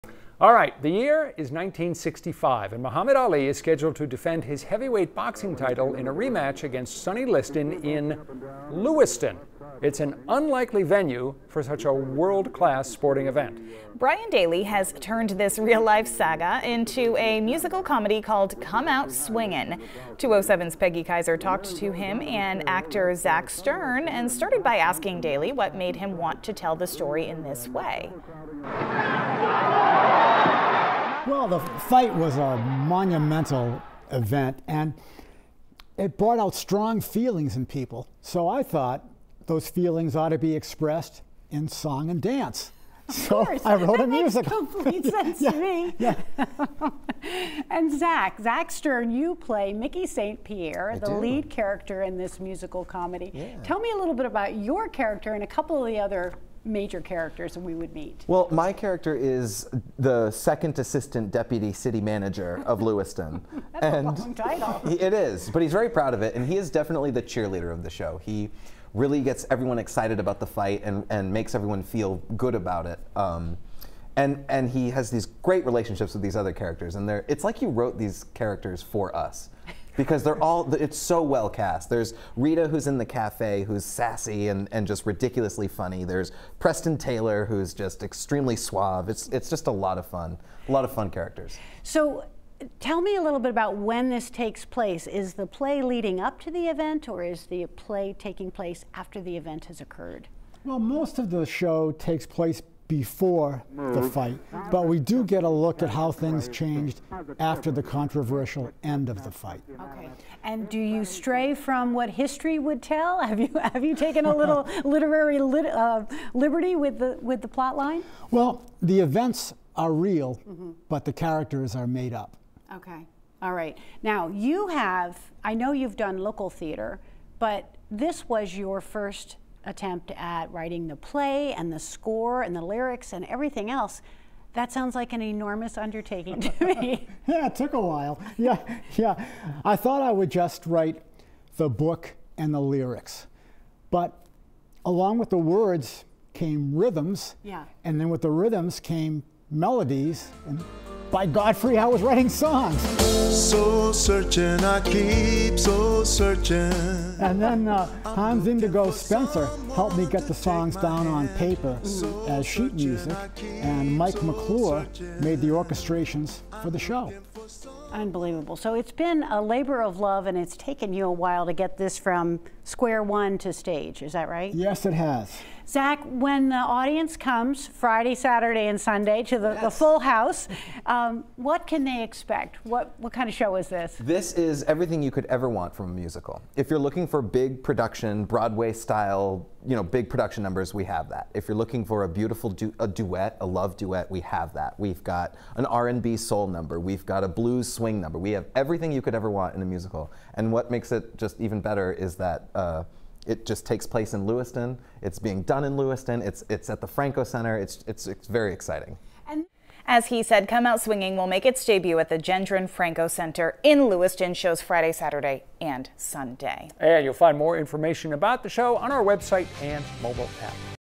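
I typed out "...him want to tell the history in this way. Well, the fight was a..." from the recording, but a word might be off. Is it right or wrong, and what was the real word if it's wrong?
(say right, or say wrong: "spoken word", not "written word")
wrong: "story", not "history".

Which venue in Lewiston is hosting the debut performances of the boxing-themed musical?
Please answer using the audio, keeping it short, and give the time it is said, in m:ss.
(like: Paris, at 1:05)
Gendron Franco Center, at 3:32.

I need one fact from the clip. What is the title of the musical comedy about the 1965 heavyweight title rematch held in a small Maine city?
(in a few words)
Come Out Swingin'.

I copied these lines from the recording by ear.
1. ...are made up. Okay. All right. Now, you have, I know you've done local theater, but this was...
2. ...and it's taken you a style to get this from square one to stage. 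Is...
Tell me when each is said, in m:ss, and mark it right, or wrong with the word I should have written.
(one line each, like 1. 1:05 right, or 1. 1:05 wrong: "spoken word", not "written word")
1. 2:01 right
2. 2:50 wrong: "while", not "style".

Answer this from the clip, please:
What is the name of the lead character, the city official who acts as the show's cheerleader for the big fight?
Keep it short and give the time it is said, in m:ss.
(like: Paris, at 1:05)
Mickey St. Pierre, at 0:49.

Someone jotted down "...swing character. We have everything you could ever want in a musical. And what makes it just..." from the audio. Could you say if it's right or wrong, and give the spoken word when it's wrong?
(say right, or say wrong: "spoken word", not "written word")
wrong: "number", not "character".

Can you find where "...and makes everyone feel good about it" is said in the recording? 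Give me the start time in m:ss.
1:11.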